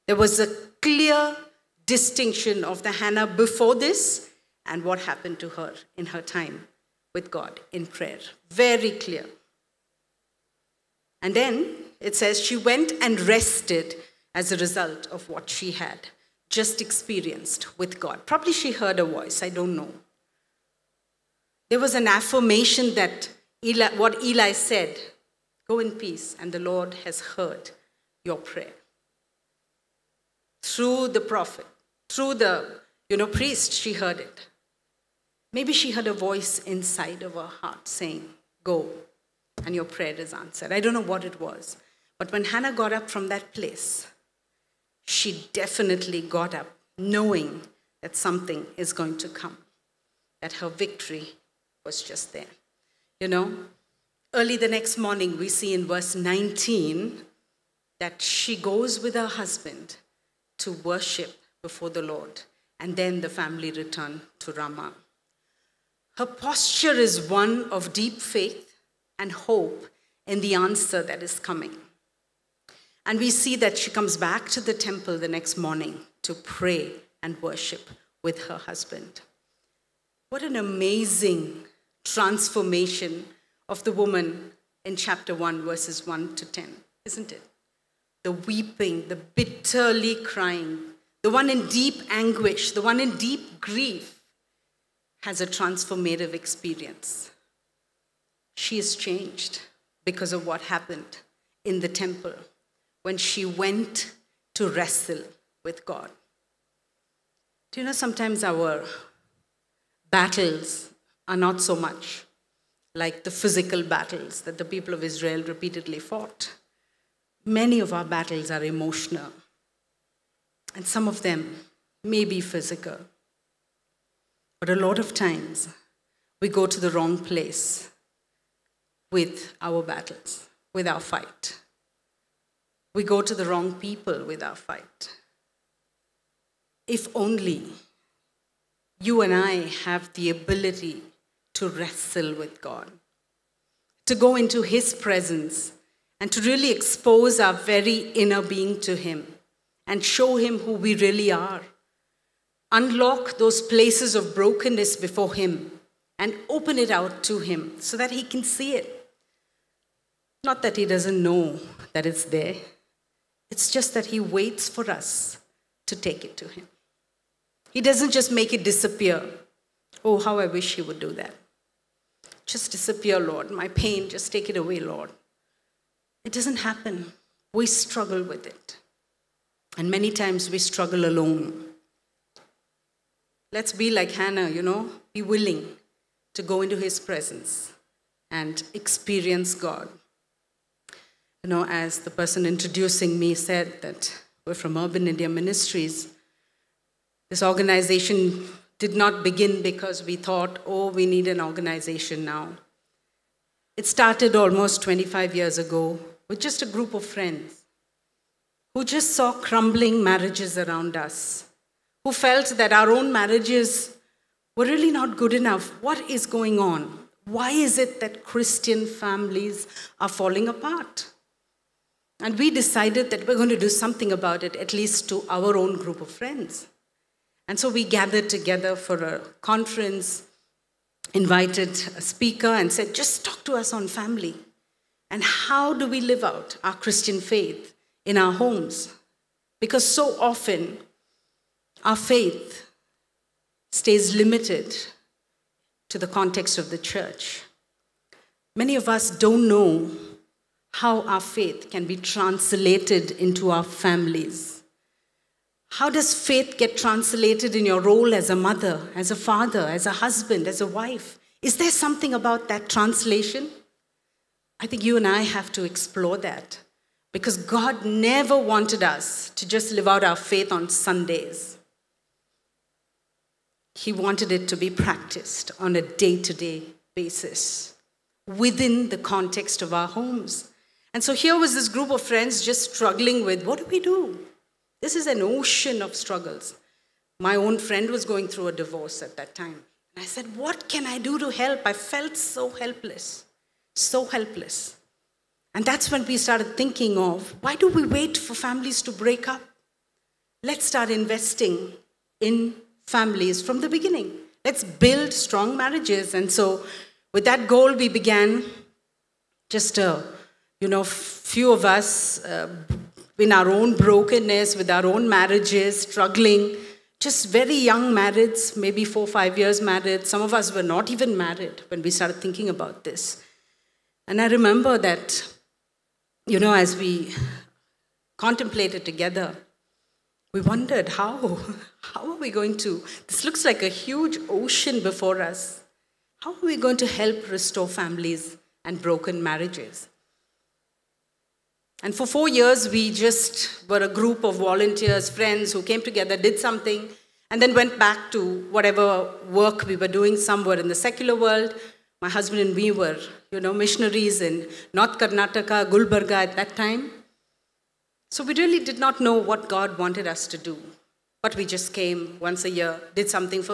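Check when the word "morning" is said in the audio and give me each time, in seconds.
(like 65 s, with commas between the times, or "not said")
54 s, 75 s.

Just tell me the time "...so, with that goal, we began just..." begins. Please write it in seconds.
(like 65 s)
306 s.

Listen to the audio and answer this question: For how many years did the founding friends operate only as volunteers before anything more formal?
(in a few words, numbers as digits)
4.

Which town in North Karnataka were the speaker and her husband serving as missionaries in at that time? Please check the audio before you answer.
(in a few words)
Gulbarga.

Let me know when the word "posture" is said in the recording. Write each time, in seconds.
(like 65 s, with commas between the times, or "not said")
66 s.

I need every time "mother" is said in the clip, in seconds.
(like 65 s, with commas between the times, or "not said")
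258 s.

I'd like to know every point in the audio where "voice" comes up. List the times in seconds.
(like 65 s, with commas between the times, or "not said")
19 s, 36 s.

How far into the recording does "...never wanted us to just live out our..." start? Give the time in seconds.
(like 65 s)
267 s.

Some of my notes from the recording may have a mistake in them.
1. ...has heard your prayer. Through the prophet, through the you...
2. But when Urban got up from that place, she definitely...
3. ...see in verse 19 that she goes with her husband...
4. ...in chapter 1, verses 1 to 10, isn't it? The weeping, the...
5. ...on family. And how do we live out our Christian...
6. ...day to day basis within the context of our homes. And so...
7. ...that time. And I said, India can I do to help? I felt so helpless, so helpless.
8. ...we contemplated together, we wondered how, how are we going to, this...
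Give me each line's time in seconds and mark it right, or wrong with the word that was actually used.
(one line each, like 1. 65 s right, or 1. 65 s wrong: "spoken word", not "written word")
1. 27 s right
2. 42 s wrong: "Hannah", not "Urban"
3. 55 s right
4. 84 s right
5. 233 s right
6. 275 s right
7. 289 s wrong: "What", not "India"
8. 326 s right.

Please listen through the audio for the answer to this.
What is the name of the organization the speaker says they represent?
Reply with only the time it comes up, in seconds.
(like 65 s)
194 s.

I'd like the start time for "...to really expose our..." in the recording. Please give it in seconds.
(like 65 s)
146 s.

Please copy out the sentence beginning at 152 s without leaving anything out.
Unlock those places of brokenness before Him and open it out to Him so that He can see it.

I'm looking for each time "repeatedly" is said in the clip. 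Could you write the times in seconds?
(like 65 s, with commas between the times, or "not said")
115 s.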